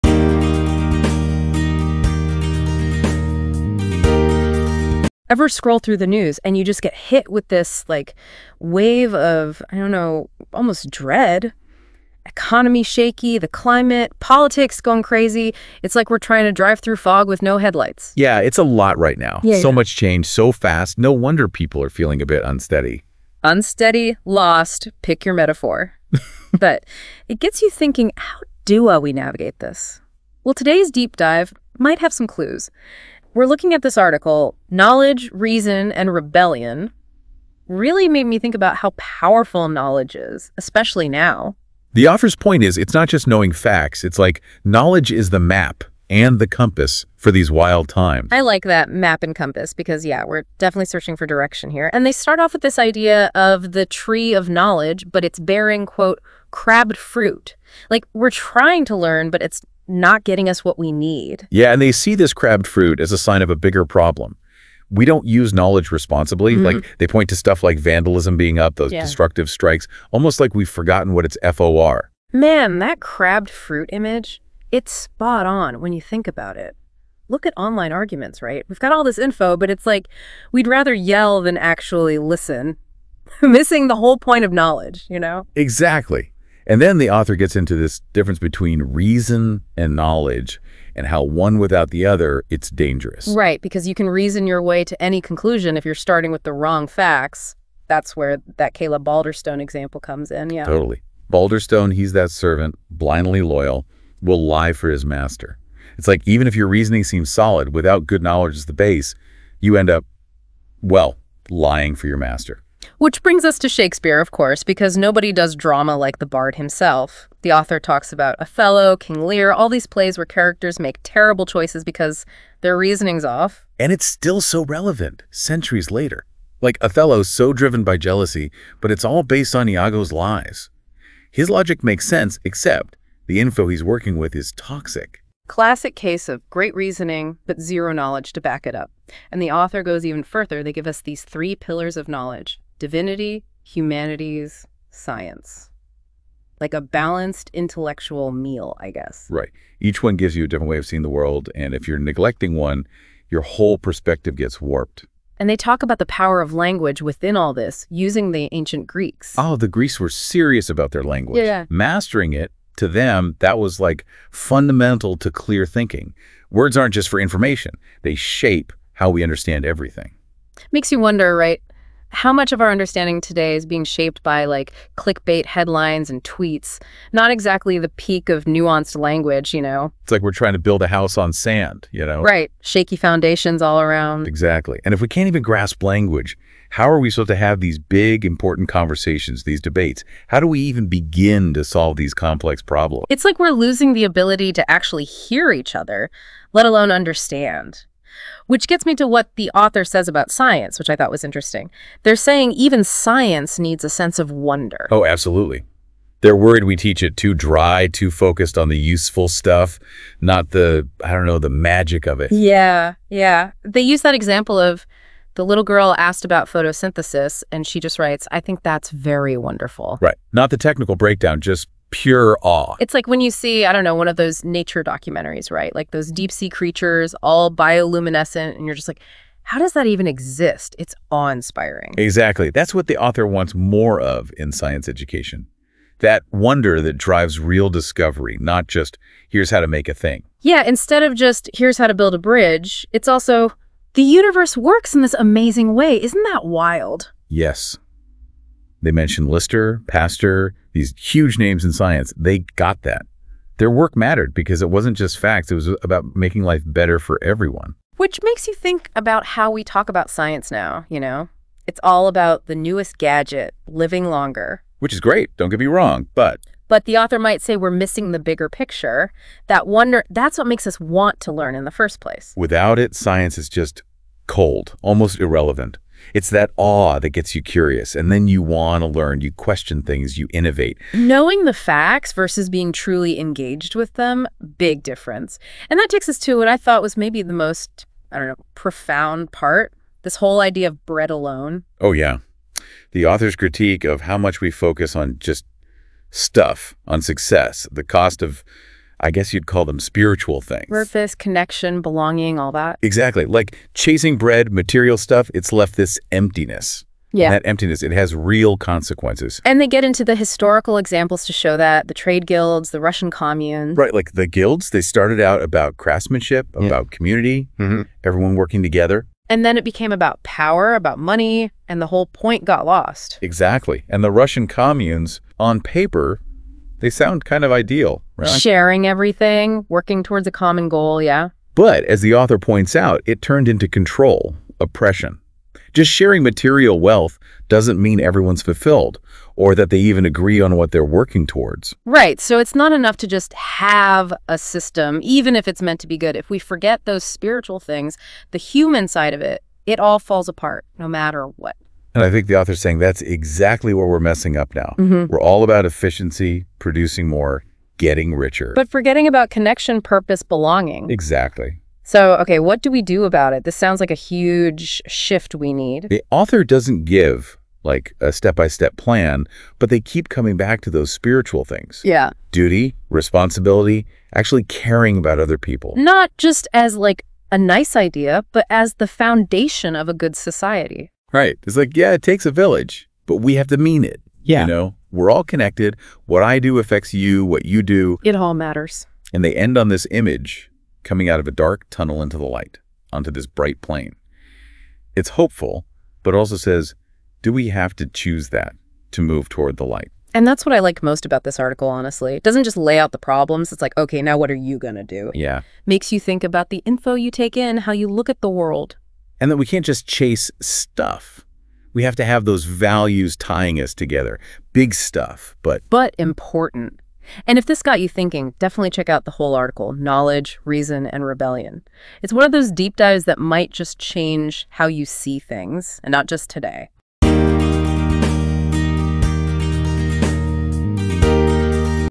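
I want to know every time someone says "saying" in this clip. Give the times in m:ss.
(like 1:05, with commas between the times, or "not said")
3:22, 5:52.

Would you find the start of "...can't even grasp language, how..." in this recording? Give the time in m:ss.
3:05.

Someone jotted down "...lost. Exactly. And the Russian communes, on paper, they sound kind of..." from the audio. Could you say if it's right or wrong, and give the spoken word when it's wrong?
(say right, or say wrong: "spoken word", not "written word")
right.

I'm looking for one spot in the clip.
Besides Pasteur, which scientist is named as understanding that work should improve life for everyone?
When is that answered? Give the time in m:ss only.
4:09.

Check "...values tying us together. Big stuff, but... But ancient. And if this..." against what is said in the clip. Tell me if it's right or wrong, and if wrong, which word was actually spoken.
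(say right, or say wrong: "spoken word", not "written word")
wrong: "important", not "ancient".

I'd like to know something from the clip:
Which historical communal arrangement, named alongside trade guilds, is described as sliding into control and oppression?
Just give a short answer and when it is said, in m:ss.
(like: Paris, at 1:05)
the Russian commune, at 5:12.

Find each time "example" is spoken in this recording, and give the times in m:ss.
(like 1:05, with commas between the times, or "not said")
1:39, 3:34, 5:10.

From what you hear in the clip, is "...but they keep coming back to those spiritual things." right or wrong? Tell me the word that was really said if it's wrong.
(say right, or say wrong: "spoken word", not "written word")
right.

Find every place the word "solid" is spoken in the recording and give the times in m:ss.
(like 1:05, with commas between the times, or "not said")
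1:47.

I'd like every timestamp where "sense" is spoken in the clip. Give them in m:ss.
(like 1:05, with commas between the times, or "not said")
2:12, 3:23.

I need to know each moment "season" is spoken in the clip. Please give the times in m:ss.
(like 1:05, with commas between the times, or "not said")
not said.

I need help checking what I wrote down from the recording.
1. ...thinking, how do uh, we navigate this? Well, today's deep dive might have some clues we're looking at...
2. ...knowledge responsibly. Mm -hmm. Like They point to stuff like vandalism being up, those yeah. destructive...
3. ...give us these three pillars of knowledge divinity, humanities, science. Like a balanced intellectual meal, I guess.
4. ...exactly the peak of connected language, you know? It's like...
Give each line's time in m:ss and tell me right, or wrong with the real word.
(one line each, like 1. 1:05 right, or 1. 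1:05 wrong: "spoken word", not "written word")
1. 0:27 right
2. 1:05 right
3. 2:20 right
4. 2:57 wrong: "nuanced", not "connected".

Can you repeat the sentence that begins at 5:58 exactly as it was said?
But forgetting about connection, purpose, belonging.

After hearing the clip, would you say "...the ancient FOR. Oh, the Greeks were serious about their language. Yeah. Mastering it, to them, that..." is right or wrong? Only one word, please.
wrong.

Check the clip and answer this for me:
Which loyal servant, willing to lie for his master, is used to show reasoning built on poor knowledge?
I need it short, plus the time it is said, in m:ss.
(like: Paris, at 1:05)
Caleb Balderstone, at 1:38.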